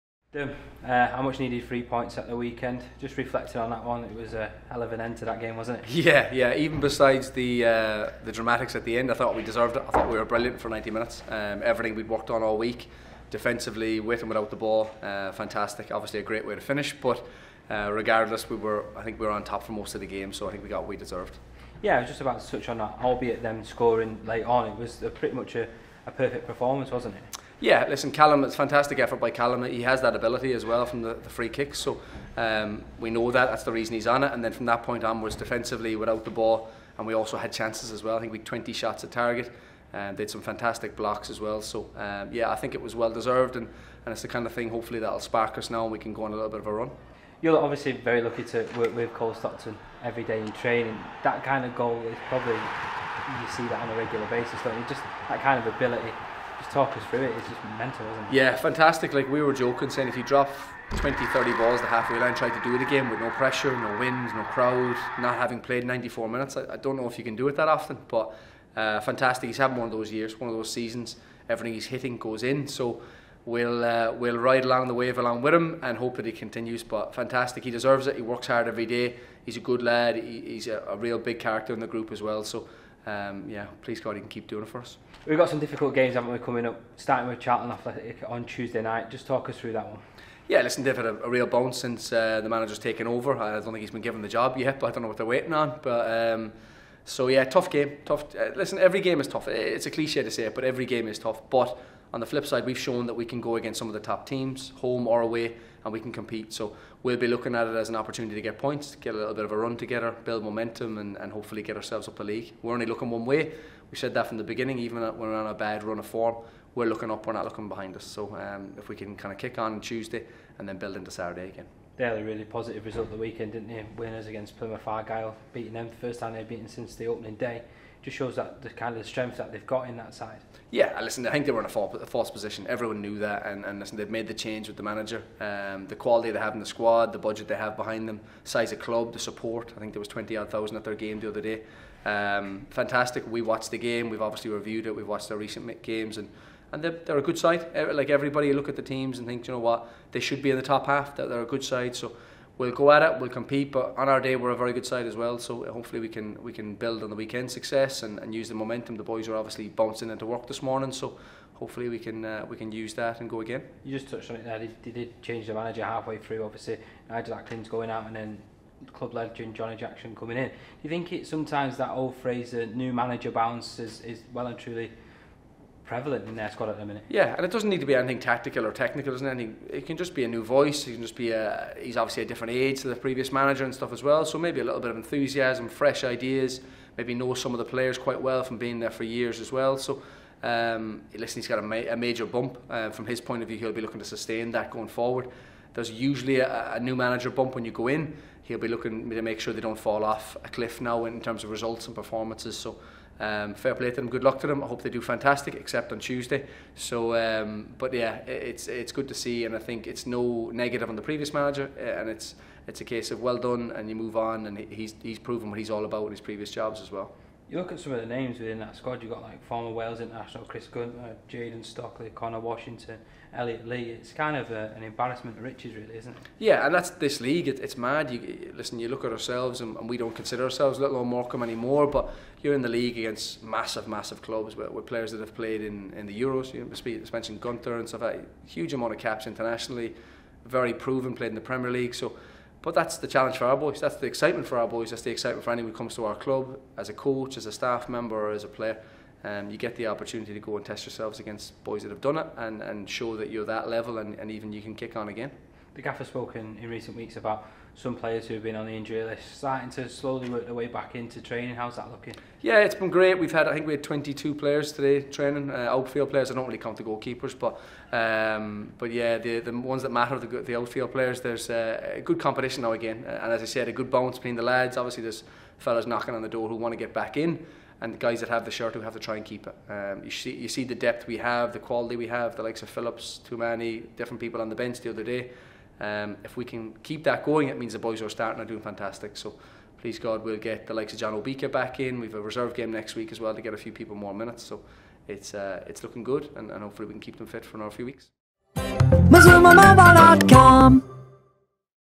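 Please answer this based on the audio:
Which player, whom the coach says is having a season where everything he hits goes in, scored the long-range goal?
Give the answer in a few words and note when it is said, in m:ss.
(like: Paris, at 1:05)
Cole Stockton, at 0:49.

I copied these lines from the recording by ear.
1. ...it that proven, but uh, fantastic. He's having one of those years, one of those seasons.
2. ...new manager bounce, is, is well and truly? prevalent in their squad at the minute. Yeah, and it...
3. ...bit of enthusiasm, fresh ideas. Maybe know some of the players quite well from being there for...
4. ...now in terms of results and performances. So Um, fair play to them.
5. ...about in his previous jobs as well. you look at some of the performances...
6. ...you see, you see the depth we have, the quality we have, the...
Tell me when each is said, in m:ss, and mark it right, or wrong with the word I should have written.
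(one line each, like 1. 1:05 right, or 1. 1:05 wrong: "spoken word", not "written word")
1. 1:07 wrong: "often", not "proven"
2. 2:52 right
3. 3:04 right
4. 3:20 right
5. 3:35 wrong: "names", not "performances"
6. 4:40 right.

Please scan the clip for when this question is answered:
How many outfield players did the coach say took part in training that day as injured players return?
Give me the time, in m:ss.
4:23.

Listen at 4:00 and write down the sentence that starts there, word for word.
Very proven, played in the Premier League.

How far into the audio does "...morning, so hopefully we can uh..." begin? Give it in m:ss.
2:40.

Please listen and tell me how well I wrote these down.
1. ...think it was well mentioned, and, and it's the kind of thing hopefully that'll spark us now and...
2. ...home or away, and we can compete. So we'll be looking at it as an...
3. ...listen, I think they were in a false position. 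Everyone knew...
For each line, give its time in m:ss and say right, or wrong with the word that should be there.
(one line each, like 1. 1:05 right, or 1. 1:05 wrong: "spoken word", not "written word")
1. 0:42 wrong: "deserved", not "mentioned"
2. 1:44 right
3. 2:11 right.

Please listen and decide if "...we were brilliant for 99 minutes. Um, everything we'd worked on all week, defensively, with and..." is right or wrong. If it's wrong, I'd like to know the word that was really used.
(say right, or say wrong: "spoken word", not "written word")
wrong: "90", not "99".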